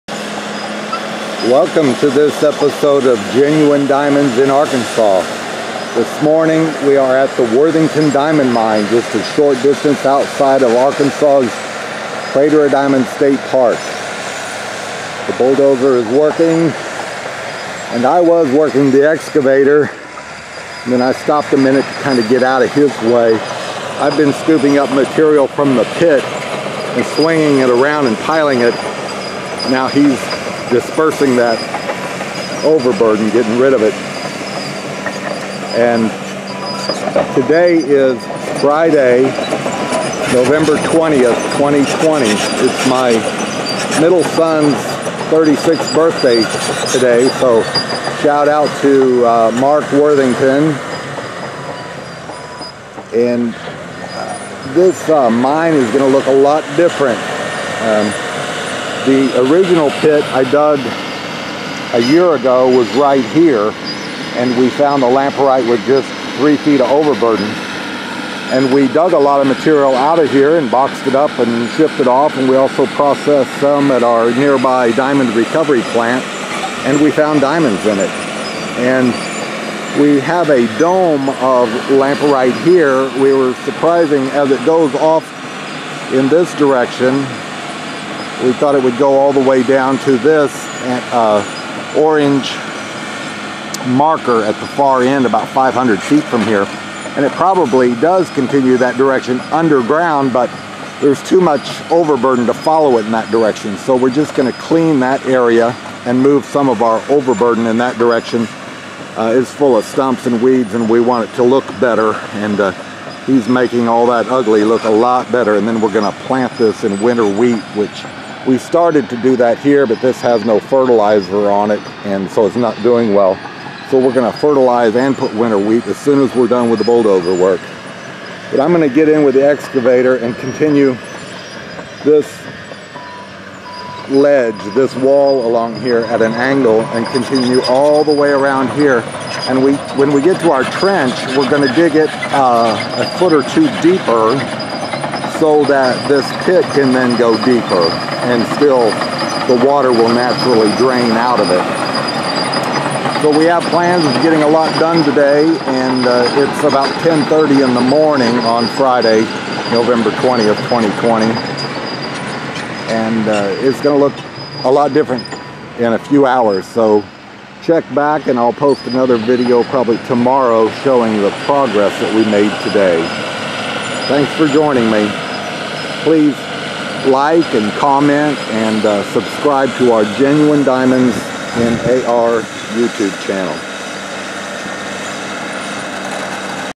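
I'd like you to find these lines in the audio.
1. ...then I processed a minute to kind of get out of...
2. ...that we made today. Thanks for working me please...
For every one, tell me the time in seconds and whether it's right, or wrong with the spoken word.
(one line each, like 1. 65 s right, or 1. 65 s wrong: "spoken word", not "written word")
1. 20 s wrong: "stopped", not "processed"
2. 171 s wrong: "joining", not "working".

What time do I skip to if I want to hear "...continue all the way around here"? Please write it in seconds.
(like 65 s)
137 s.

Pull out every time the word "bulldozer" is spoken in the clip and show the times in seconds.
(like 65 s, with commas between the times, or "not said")
15 s, 126 s.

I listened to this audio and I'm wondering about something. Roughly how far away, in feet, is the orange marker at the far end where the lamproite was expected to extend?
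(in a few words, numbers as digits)
500 feet.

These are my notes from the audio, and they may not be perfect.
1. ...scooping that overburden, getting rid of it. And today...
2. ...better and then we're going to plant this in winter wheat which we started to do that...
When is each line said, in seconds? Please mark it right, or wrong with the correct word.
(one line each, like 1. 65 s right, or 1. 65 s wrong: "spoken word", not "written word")
1. 30 s wrong: "dispersing", not "scooping"
2. 115 s right.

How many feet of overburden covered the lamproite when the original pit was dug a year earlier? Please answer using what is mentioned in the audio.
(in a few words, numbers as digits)
3 feet.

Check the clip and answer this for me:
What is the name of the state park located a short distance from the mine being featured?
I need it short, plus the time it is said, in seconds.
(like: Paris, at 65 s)
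Crater Diamond State Park, at 12 s.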